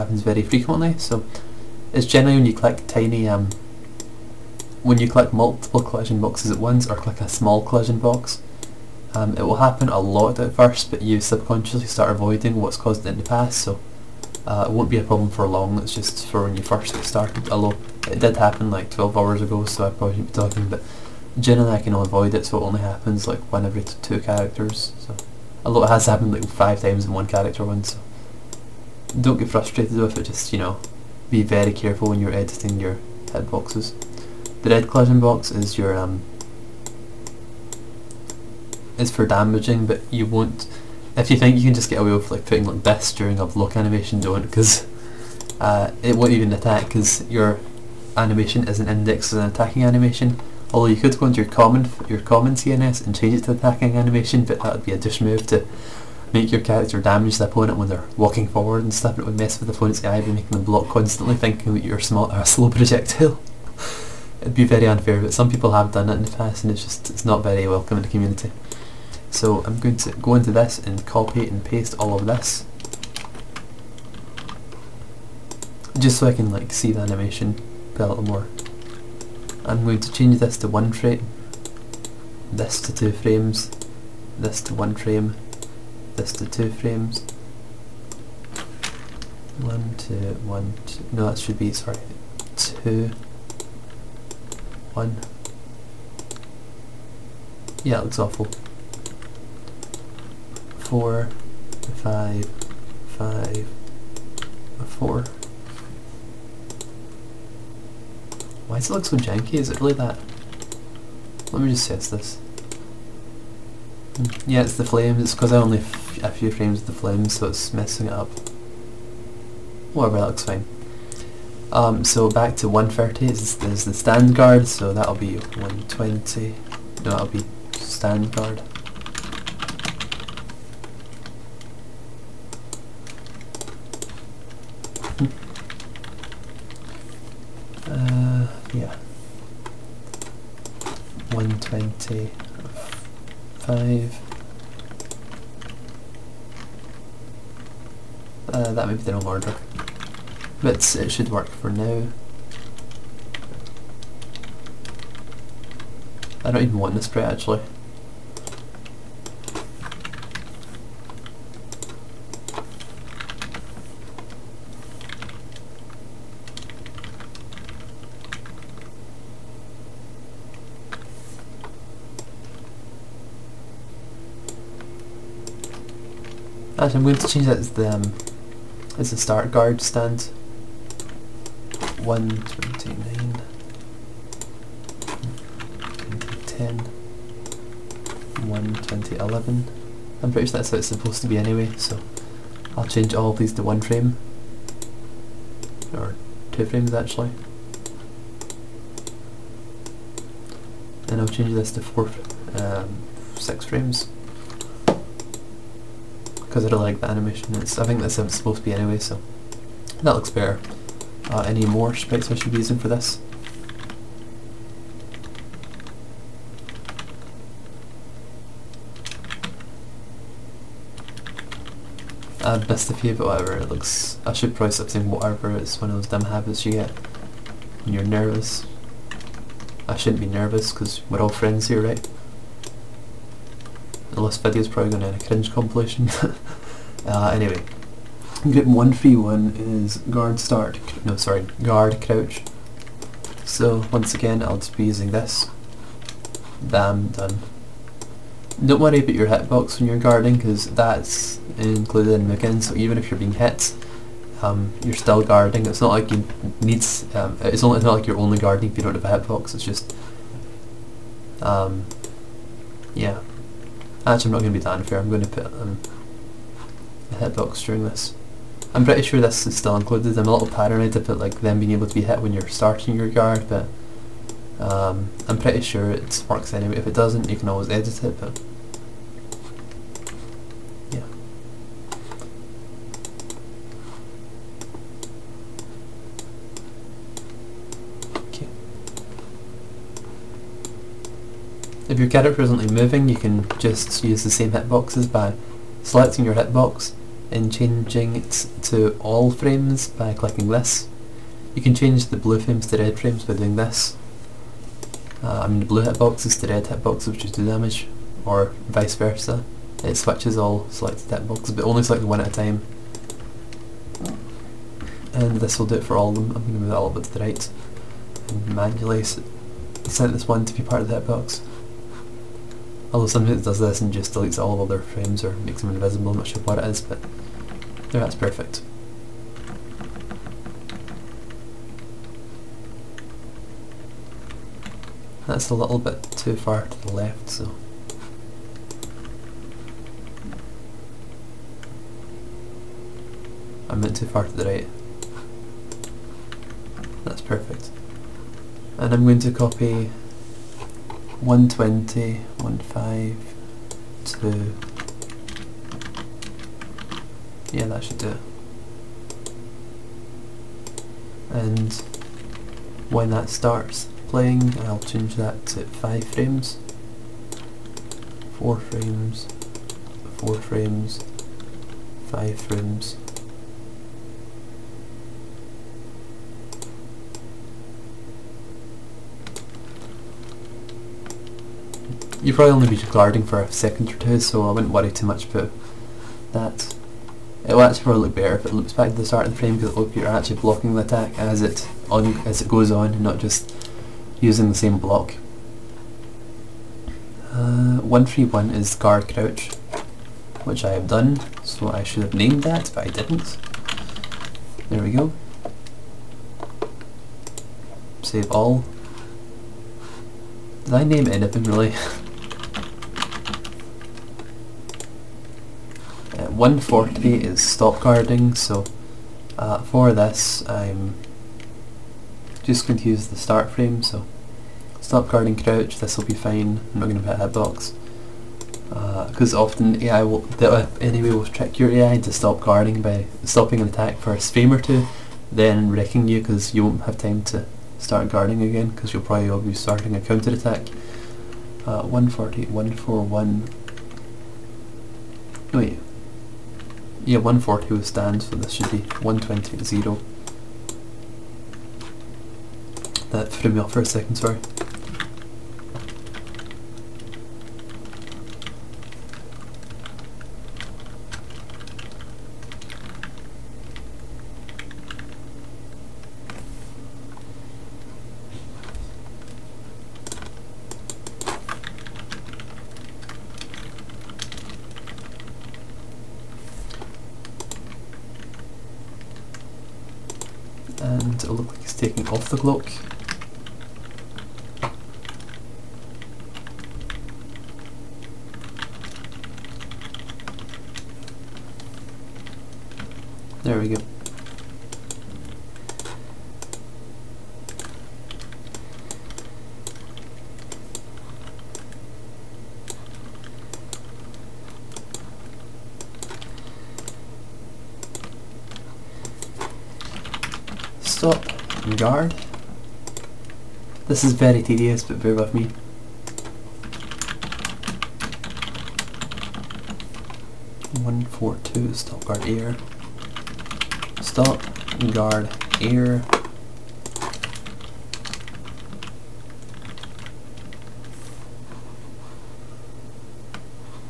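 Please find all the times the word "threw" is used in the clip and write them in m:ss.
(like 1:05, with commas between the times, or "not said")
7:33.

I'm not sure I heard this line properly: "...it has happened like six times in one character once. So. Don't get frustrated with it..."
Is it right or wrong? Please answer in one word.
wrong.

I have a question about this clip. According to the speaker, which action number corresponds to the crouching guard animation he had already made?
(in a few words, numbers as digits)
131.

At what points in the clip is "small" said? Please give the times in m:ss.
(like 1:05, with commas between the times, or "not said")
0:07, 1:02.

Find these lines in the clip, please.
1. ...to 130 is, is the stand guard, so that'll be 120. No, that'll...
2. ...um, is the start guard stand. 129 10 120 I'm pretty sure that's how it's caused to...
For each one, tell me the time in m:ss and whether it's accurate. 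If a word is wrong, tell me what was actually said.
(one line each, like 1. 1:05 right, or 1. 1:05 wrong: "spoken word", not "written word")
1. 2:02 right
2. 2:57 wrong: "supposed", not "caused".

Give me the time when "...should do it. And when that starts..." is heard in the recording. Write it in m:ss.
5:57.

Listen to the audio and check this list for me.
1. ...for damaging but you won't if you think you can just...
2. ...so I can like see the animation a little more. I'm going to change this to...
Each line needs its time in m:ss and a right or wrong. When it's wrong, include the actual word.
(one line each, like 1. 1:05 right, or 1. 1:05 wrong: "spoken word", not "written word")
1. 0:39 right
2. 1:16 right.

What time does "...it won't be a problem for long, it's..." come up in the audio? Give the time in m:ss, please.
0:14.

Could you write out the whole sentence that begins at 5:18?
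And manually set this one to be part of the hitbox.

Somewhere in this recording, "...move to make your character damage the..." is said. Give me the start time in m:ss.
0:55.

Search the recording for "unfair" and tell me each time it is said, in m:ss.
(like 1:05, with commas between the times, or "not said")
1:04, 4:24.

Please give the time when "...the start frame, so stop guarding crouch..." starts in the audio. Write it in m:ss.
7:03.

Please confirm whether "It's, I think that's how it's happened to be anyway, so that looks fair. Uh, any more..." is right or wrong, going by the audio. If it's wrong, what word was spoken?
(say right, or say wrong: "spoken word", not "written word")
wrong: "supposed", not "happened".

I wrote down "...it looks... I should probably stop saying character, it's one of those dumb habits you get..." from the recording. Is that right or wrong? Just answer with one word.
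wrong.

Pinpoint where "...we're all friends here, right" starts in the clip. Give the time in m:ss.
3:51.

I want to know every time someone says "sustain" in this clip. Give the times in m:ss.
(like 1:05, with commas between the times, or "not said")
not said.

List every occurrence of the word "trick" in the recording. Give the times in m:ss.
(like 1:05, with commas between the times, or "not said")
7:11.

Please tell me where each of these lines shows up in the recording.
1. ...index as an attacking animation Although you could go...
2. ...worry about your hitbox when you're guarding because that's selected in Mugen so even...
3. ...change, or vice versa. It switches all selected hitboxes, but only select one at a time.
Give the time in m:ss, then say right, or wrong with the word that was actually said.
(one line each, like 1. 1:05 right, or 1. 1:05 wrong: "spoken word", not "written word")
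1. 0:48 right
2. 4:08 wrong: "included", not "selected"
3. 5:07 wrong: "damage", not "change".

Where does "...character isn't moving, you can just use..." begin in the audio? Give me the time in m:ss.
4:52.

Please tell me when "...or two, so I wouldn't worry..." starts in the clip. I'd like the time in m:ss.
6:23.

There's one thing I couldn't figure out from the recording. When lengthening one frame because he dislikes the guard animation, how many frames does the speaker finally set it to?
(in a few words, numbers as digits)
6.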